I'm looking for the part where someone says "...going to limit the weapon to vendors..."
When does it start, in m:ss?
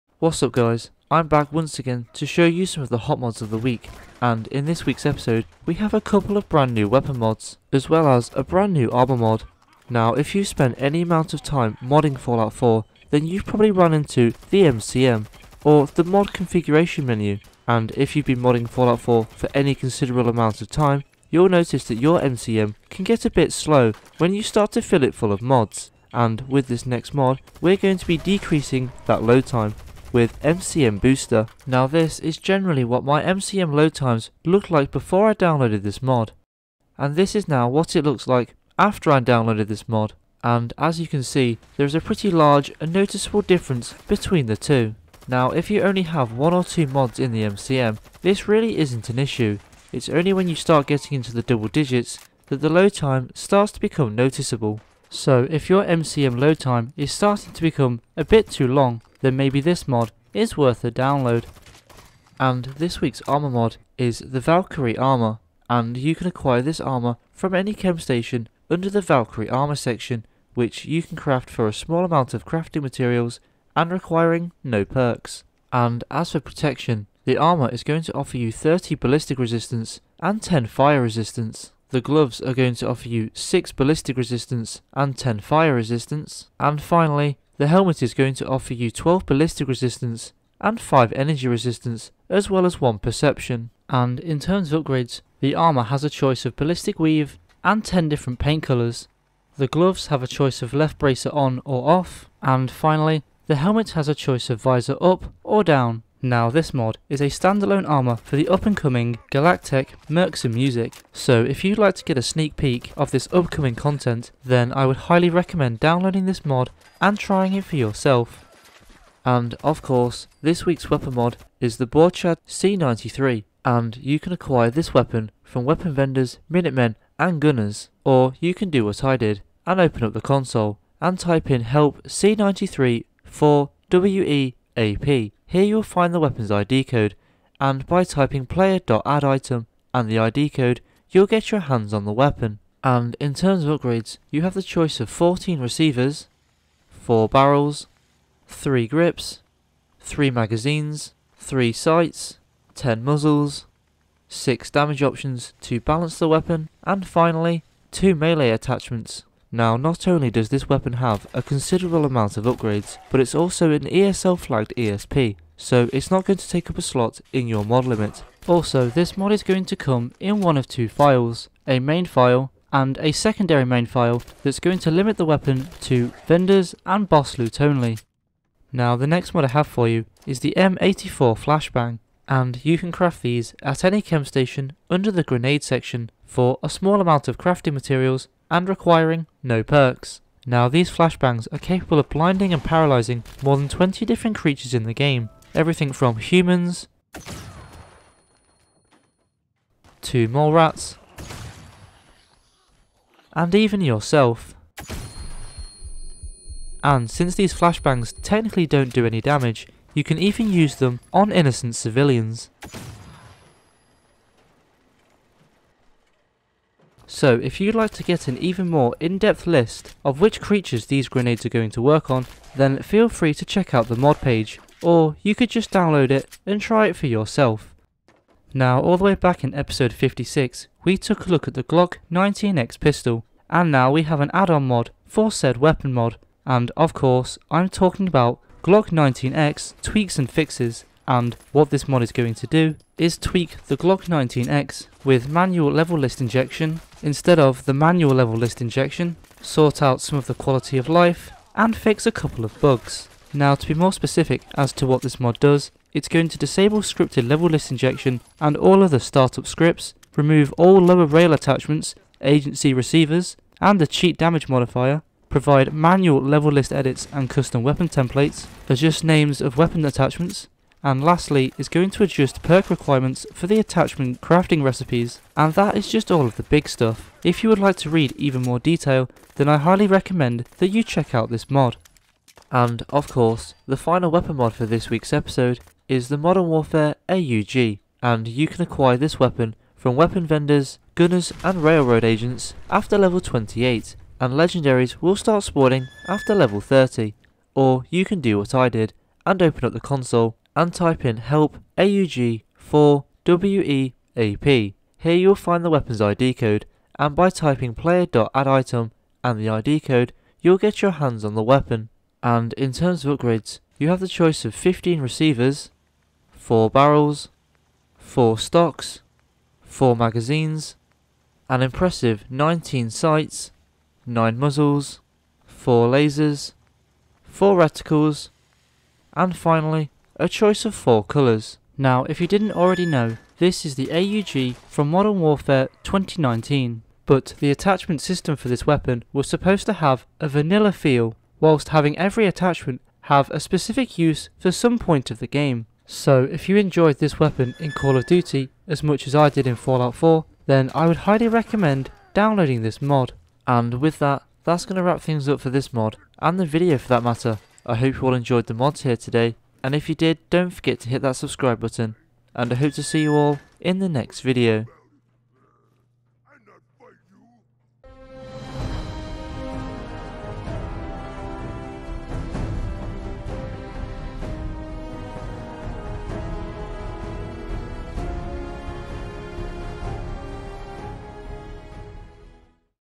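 2:54.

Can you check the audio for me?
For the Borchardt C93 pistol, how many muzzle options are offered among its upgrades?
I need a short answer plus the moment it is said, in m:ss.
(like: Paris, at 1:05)
10, at 2:32.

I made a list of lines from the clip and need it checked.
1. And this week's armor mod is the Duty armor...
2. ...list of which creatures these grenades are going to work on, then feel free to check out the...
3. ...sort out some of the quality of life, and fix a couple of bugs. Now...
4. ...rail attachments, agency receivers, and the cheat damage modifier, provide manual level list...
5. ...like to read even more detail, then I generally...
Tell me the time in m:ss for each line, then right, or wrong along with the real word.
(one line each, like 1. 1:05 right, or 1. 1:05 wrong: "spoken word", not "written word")
1. 1:02 wrong: "Valkyrie", not "Duty"
2. 3:39 right
3. 4:09 right
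4. 4:21 right
5. 4:37 wrong: "highly", not "generally".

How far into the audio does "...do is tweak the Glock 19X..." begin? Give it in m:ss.
4:02.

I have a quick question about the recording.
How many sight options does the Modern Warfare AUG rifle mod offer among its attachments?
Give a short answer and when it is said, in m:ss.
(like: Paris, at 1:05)
19, at 5:22.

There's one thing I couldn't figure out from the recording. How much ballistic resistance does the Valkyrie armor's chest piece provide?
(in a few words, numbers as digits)
30.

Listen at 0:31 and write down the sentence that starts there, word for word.
Now this is generally what my MCM load times looked like before I downloaded this mod.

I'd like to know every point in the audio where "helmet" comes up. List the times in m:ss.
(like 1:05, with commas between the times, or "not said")
1:27, 1:43.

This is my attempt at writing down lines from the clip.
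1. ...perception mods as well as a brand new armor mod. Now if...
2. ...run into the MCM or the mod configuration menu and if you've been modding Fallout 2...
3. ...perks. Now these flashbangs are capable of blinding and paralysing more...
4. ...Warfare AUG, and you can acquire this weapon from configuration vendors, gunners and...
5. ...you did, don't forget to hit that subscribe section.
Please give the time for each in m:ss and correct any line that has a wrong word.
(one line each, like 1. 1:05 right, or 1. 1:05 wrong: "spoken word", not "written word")
1. 0:06 wrong: "weapon", not "perception"
2. 0:13 wrong: "4", not "2"
3. 3:09 right
4. 4:46 wrong: "weapon", not "configuration"
5. 5:59 wrong: "button", not "section".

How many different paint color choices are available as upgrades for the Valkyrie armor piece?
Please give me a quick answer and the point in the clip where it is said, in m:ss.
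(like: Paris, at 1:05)
10, at 1:37.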